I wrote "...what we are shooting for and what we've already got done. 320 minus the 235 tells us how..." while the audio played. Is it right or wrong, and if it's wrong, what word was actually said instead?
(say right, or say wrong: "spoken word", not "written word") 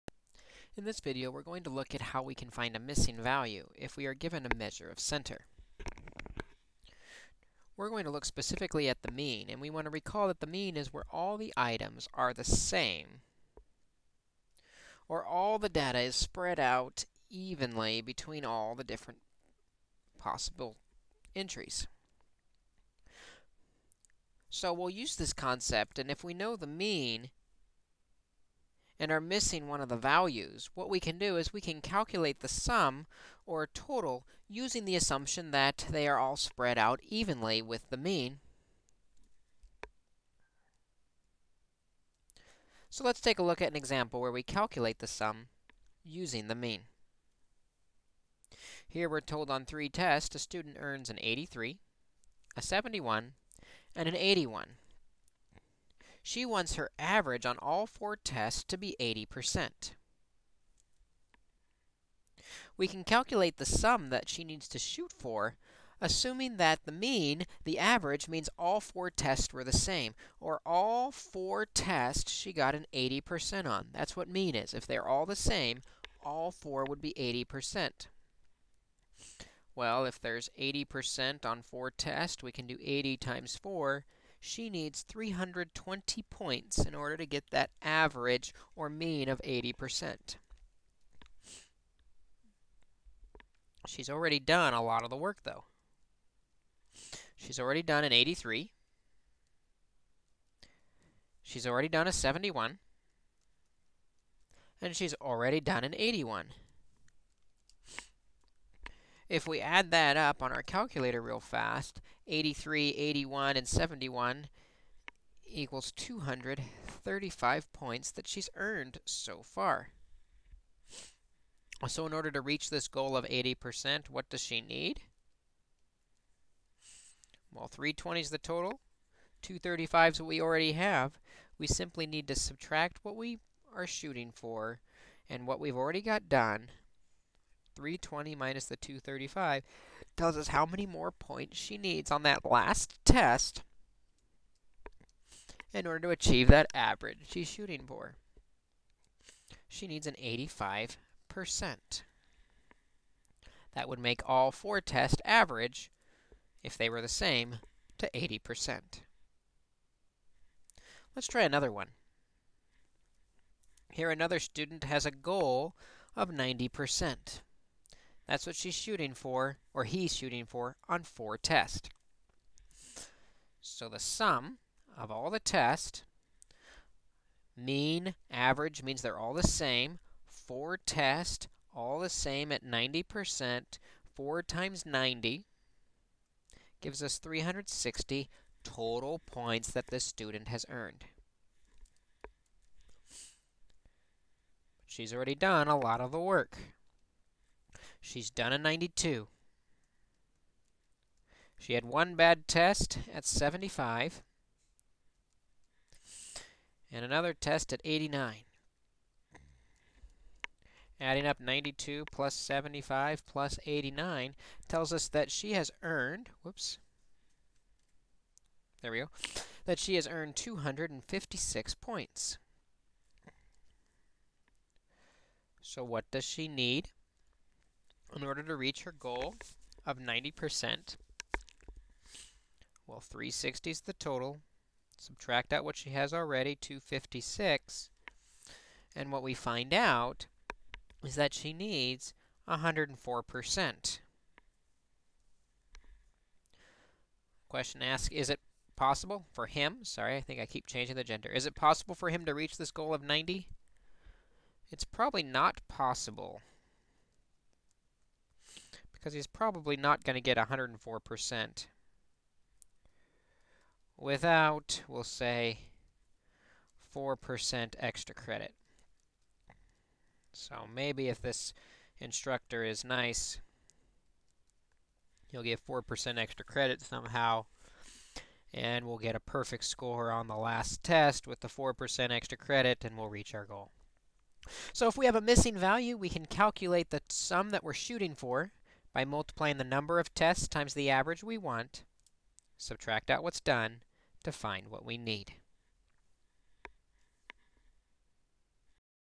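right.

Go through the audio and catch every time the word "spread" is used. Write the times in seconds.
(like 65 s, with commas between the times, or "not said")
16 s, 36 s.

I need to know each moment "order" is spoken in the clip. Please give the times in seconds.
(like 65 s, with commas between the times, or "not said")
86 s, 122 s, 145 s, 228 s.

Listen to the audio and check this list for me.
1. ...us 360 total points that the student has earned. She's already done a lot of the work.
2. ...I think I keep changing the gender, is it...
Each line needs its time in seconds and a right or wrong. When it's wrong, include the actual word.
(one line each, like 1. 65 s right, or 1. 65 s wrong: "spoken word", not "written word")
1. 187 s right
2. 250 s right.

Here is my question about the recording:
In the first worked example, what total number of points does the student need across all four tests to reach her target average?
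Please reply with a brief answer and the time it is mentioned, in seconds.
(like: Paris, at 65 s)
320, at 85 s.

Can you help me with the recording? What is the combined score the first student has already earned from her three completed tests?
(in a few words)
235.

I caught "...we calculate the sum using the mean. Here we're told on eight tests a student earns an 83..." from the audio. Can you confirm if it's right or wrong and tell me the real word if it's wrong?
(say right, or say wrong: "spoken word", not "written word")
wrong: "three", not "eight".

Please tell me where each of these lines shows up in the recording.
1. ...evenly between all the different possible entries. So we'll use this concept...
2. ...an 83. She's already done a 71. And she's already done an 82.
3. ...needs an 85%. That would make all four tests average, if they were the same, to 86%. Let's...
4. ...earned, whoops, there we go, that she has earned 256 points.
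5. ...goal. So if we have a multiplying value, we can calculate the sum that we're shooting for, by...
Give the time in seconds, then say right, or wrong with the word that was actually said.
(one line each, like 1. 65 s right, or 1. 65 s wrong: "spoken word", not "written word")
1. 17 s right
2. 98 s wrong: "81", not "82"
3. 149 s wrong: "80", not "86"
4. 215 s right
5. 283 s wrong: "missing", not "multiplying".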